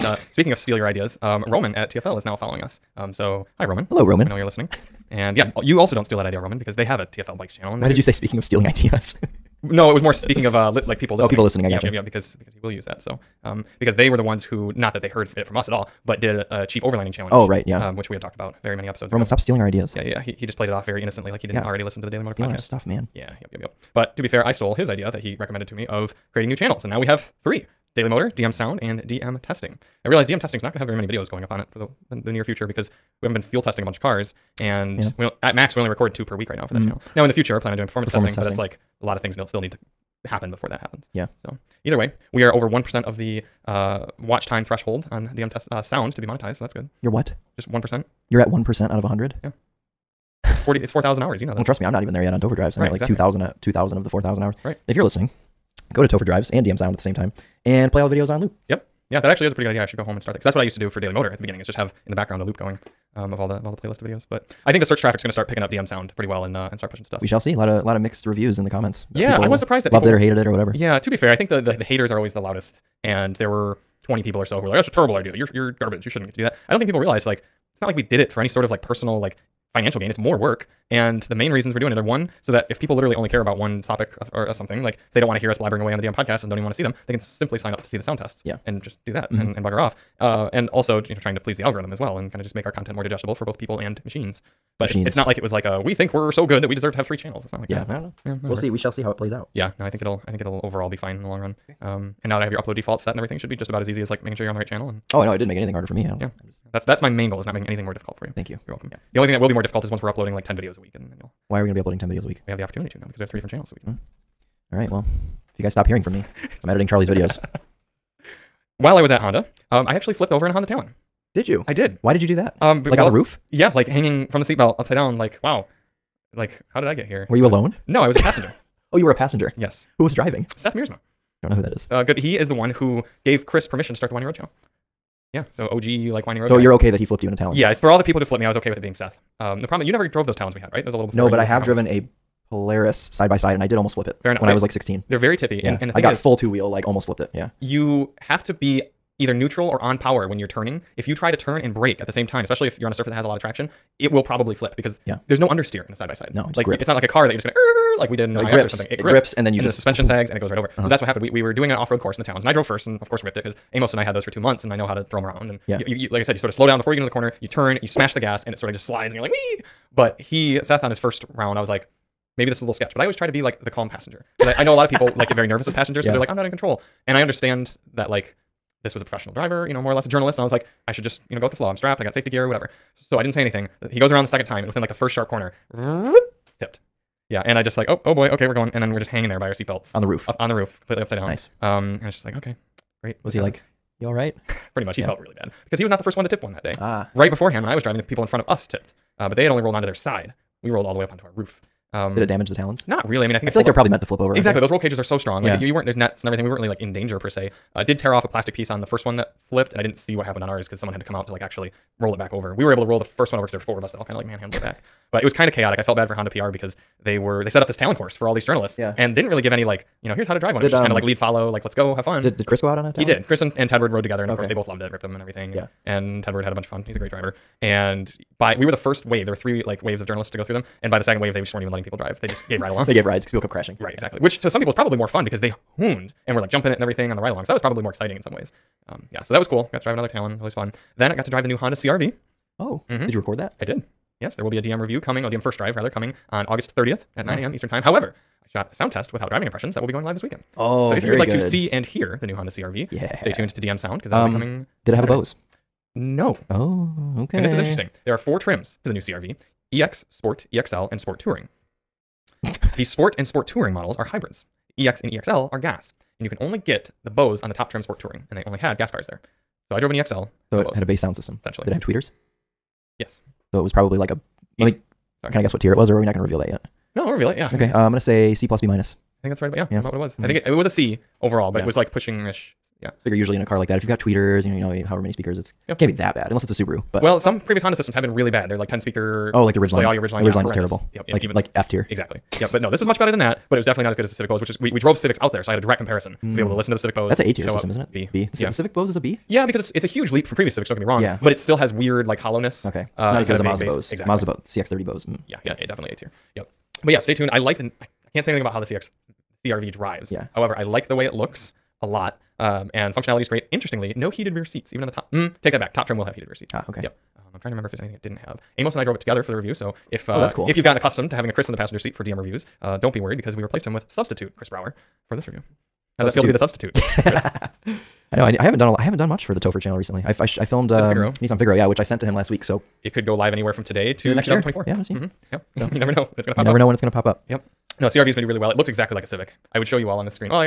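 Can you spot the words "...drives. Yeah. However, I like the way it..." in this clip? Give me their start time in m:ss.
5:09.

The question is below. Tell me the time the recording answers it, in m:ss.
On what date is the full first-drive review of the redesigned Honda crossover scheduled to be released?
4:06.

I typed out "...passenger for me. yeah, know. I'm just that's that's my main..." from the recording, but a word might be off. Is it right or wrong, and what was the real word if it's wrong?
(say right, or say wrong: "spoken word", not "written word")
wrong: "harder", not "passenger".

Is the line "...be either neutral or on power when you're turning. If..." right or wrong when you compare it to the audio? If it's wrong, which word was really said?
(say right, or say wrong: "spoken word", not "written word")
right.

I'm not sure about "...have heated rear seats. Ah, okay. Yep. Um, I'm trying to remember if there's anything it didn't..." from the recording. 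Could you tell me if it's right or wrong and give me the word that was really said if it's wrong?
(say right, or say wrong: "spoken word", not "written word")
right.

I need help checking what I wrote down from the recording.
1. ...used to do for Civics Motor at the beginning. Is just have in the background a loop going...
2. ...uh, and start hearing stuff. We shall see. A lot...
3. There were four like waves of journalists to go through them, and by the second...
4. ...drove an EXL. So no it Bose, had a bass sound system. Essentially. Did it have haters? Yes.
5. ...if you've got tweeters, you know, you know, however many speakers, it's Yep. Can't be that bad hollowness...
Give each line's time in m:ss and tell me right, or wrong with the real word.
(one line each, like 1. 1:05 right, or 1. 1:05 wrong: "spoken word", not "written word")
1. 1:00 wrong: "Daily", not "Civics"
2. 1:06 wrong: "pushing", not "hearing"
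3. 3:49 wrong: "three", not "four"
4. 4:29 wrong: "tweeters", not "haters"
5. 4:43 wrong: "unless", not "hollowness".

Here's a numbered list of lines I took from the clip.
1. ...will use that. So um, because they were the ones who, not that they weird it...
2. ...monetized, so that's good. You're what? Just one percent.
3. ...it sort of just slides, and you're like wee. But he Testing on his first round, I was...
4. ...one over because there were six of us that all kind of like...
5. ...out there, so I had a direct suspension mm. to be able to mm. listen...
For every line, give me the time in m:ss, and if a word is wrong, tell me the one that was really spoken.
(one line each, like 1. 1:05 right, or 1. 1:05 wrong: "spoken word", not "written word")
1. 0:12 wrong: "heard", not "weird"
2. 0:46 right
3. 2:48 wrong: "Seth", not "Testing"
4. 3:33 wrong: "four", not "six"
5. 4:55 wrong: "comparison", not "suspension".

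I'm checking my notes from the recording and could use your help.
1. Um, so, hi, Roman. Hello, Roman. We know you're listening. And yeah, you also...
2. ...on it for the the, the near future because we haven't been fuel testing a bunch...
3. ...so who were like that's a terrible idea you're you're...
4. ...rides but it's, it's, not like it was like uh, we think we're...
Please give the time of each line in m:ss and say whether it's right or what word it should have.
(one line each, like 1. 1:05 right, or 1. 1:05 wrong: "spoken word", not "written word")
1. 0:02 right
2. 0:31 right
3. 1:14 right
4. 1:34 wrong: "machines", not "rides".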